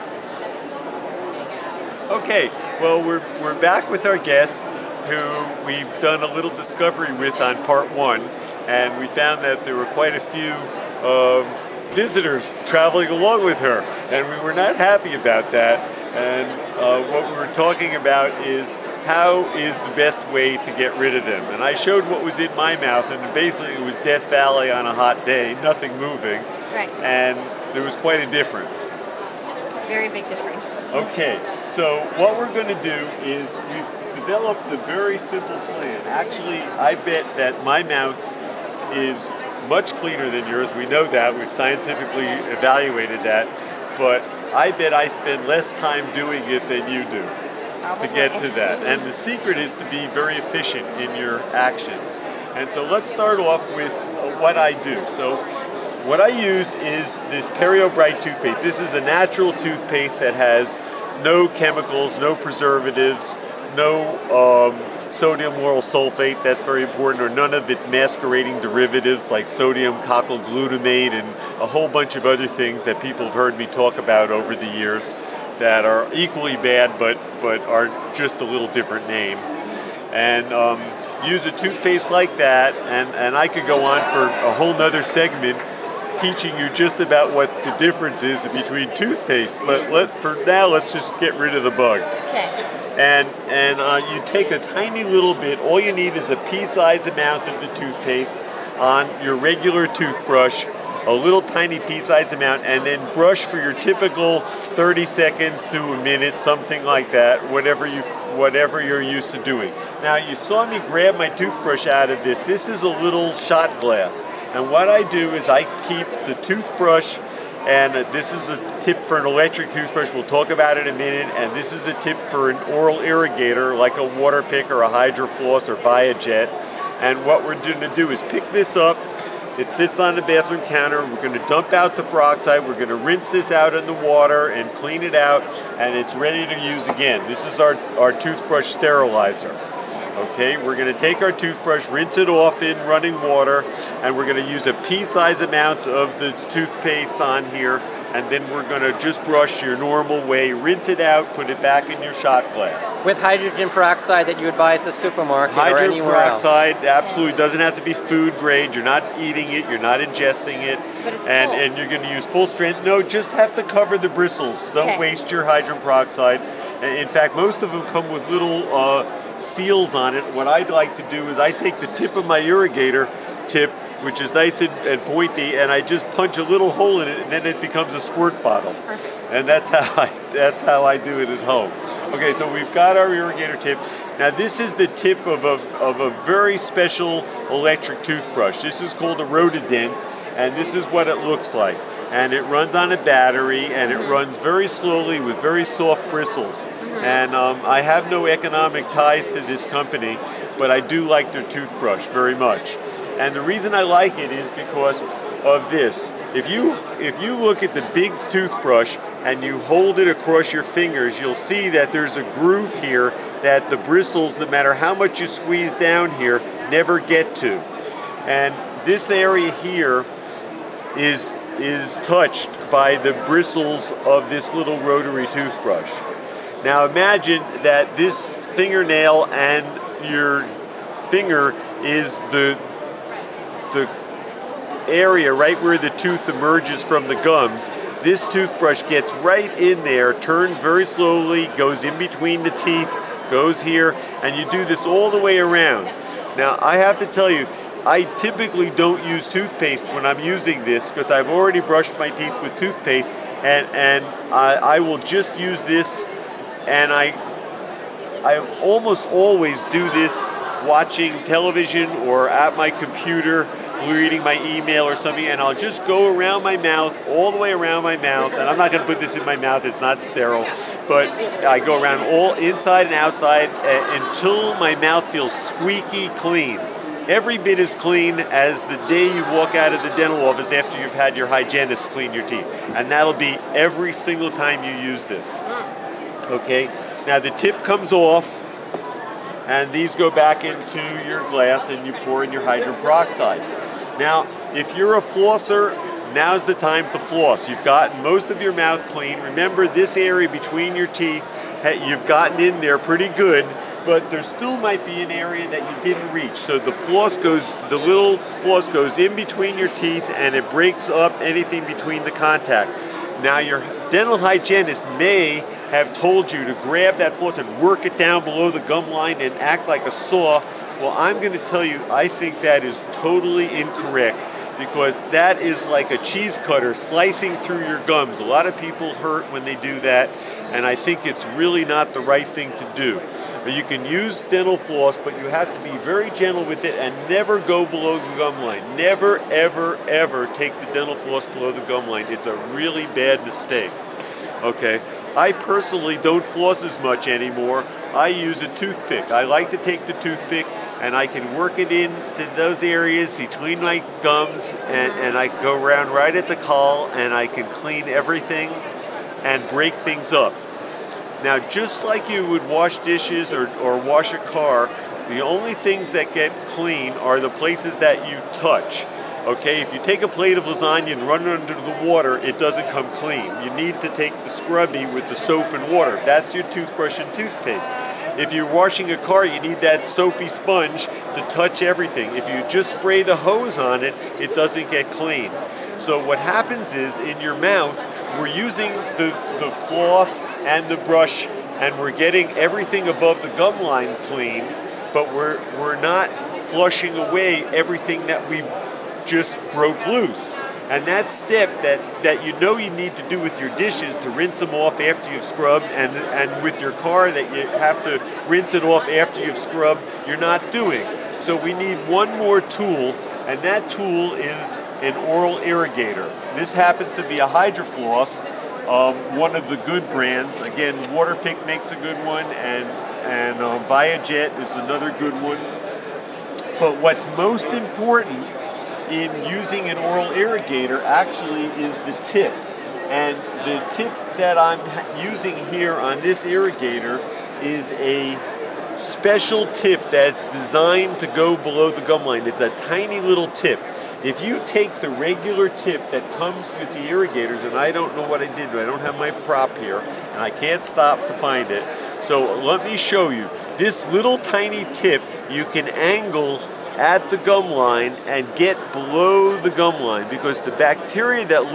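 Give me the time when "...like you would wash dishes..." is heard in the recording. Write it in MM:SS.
06:01.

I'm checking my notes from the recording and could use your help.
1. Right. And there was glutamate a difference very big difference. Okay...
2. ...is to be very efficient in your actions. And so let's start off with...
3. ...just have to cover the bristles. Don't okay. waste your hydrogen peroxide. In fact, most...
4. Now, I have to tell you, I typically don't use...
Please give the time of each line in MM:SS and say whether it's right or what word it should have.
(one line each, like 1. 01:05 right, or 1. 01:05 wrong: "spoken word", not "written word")
1. 00:26 wrong: "quite", not "glutamate"
2. 00:49 right
3. 02:43 right
4. 04:06 right.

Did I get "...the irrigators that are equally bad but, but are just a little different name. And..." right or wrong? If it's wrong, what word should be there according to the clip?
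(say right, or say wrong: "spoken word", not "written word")
wrong: "years", not "irrigators".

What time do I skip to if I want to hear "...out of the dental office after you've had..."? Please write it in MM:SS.
04:39.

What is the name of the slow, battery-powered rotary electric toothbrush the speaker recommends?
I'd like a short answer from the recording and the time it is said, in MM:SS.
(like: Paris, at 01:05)
Rotadent, at 03:09.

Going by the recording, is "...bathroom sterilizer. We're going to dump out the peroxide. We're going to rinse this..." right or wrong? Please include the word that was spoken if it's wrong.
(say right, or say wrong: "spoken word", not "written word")
wrong: "counter", not "sterilizer".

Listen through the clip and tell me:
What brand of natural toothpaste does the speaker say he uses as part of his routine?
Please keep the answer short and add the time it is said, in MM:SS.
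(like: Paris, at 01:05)
Perio Bright, at 00:57.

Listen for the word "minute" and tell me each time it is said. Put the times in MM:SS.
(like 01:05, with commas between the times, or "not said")
01:46, 02:00.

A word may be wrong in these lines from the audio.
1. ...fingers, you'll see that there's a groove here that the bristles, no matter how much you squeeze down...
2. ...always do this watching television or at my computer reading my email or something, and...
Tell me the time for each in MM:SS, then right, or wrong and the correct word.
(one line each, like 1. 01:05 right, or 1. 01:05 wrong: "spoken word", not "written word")
1. 03:30 right
2. 04:19 right.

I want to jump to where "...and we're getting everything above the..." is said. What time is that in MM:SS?
06:31.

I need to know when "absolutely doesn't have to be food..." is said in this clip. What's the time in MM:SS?
02:37.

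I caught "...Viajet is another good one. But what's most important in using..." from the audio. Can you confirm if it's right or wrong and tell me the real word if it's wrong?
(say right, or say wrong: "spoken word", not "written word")
right.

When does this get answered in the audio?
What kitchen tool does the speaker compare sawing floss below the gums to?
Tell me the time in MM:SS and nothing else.
05:25.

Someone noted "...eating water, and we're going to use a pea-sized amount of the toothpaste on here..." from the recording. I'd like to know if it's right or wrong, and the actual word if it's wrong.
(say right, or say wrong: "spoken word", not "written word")
wrong: "running", not "eating".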